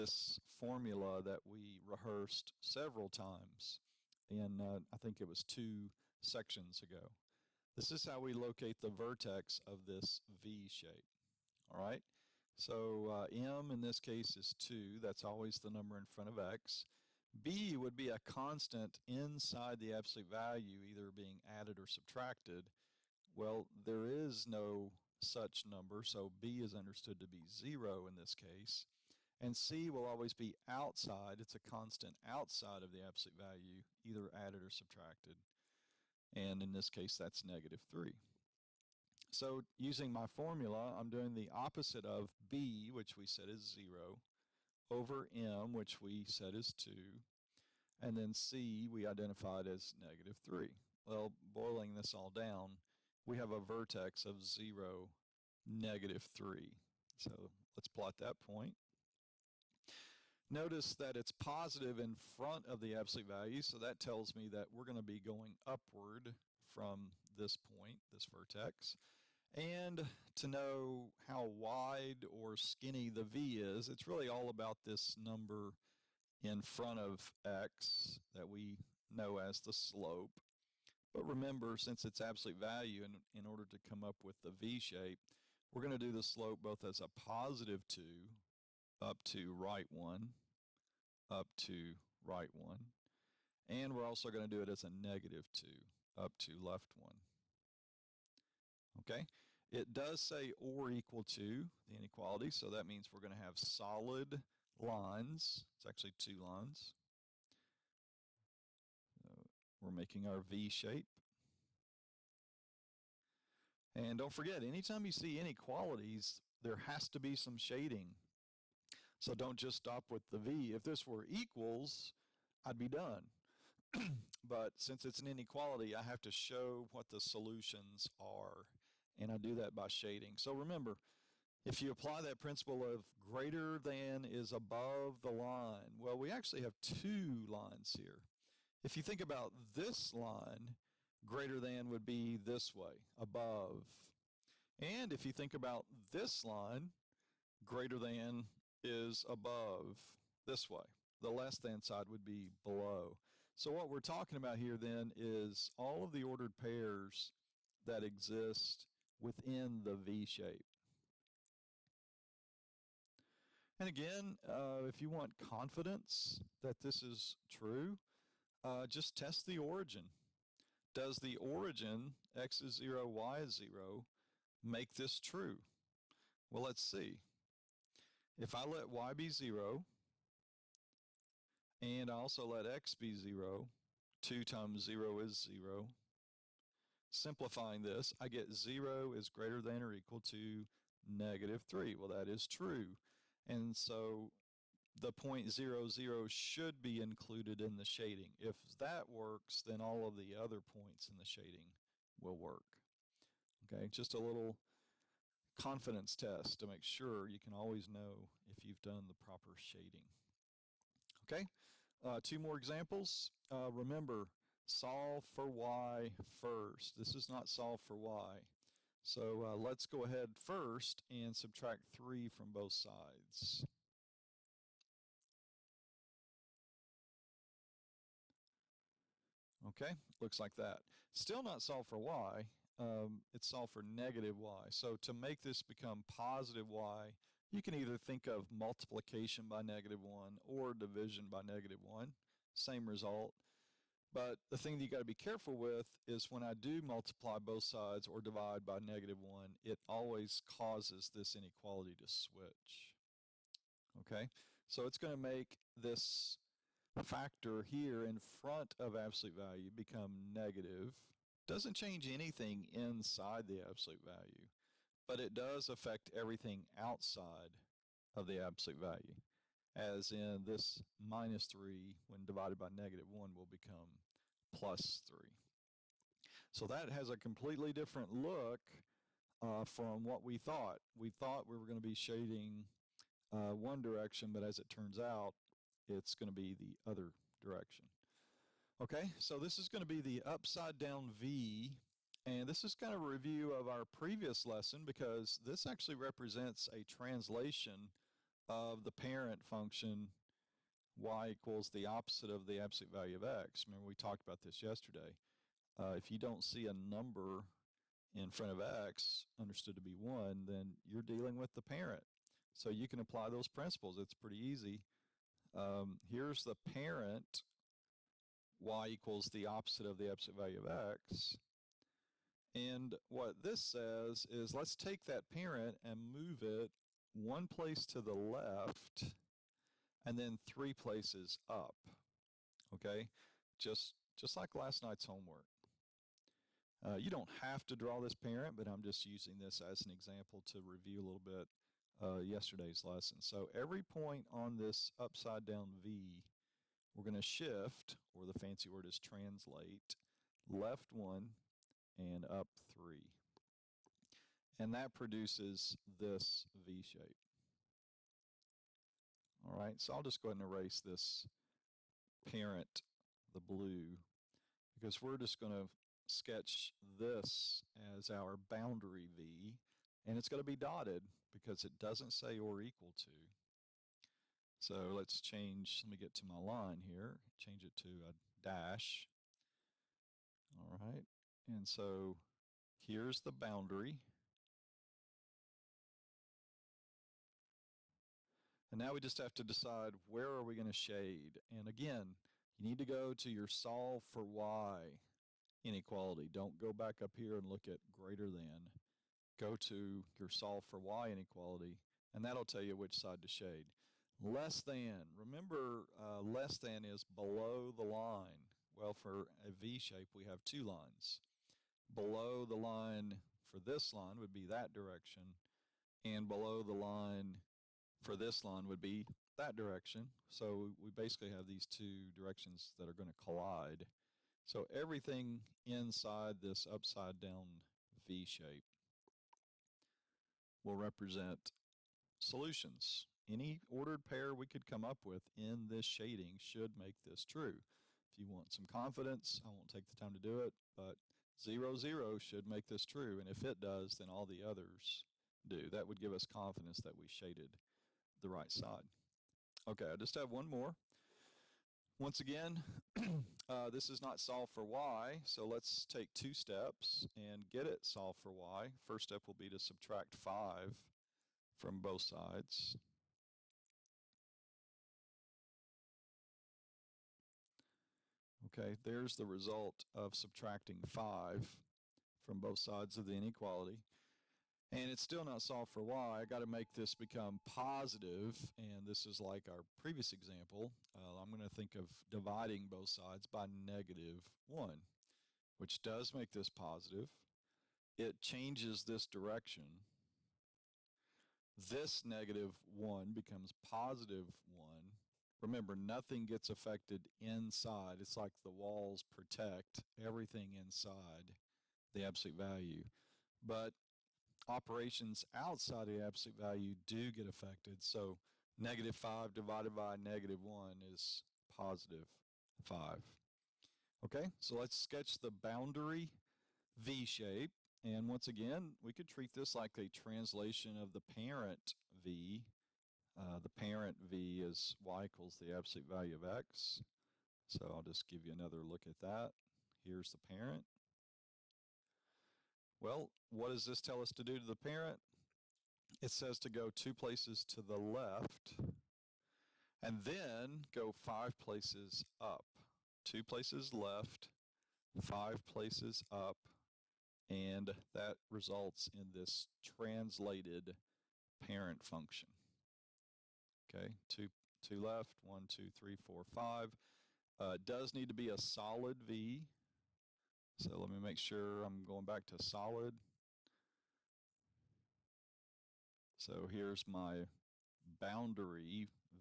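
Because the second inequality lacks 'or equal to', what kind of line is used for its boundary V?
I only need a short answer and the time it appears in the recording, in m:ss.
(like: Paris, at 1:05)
dotted, at 6:10.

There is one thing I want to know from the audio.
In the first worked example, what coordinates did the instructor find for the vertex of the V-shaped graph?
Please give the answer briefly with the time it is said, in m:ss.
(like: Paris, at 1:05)
(0, -3), at 0:54.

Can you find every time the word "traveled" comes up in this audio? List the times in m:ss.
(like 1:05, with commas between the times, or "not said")
not said.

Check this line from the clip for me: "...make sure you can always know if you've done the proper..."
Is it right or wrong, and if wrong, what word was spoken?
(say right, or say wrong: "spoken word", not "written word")
right.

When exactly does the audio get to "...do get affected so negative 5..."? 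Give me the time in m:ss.
8:26.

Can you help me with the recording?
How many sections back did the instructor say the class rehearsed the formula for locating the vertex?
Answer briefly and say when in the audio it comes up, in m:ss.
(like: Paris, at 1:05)
2, at 0:05.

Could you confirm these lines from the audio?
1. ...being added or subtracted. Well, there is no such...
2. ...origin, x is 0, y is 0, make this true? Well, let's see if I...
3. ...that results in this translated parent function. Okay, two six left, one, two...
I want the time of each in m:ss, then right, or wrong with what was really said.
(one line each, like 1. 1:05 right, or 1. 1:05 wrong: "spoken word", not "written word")
1. 0:21 right
2. 2:51 right
3. 9:07 wrong: "two", not "six".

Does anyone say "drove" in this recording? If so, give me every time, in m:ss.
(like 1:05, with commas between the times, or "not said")
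not said.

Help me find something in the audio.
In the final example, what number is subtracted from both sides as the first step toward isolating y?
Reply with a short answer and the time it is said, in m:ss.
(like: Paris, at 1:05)
5, at 7:39.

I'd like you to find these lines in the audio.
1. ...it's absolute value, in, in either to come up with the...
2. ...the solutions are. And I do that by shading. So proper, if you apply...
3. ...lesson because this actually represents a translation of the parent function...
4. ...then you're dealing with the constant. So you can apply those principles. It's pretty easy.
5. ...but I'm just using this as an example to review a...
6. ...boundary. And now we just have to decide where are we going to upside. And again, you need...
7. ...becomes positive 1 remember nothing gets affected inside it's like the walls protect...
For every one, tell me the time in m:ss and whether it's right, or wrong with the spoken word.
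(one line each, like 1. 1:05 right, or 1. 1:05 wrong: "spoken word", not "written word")
1. 1:22 wrong: "order", not "either"
2. 2:07 wrong: "remember", not "proper"
3. 4:54 right
4. 5:10 wrong: "parent", not "constant"
5. 5:38 right
6. 6:23 wrong: "shade", not "upside"
7. 8:13 right.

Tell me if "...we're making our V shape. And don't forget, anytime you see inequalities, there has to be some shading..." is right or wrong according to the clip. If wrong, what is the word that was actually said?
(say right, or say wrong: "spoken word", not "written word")
right.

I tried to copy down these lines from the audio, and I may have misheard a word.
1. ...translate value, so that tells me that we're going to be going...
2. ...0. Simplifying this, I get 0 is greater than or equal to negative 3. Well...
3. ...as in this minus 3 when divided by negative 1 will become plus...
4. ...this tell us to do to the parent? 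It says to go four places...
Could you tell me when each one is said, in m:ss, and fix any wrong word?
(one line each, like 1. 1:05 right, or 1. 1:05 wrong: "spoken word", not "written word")
1. 1:02 wrong: "absolute", not "translate"
2. 3:05 right
3. 4:29 right
4. 8:53 wrong: "two", not "four".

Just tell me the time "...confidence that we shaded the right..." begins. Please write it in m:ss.
7:26.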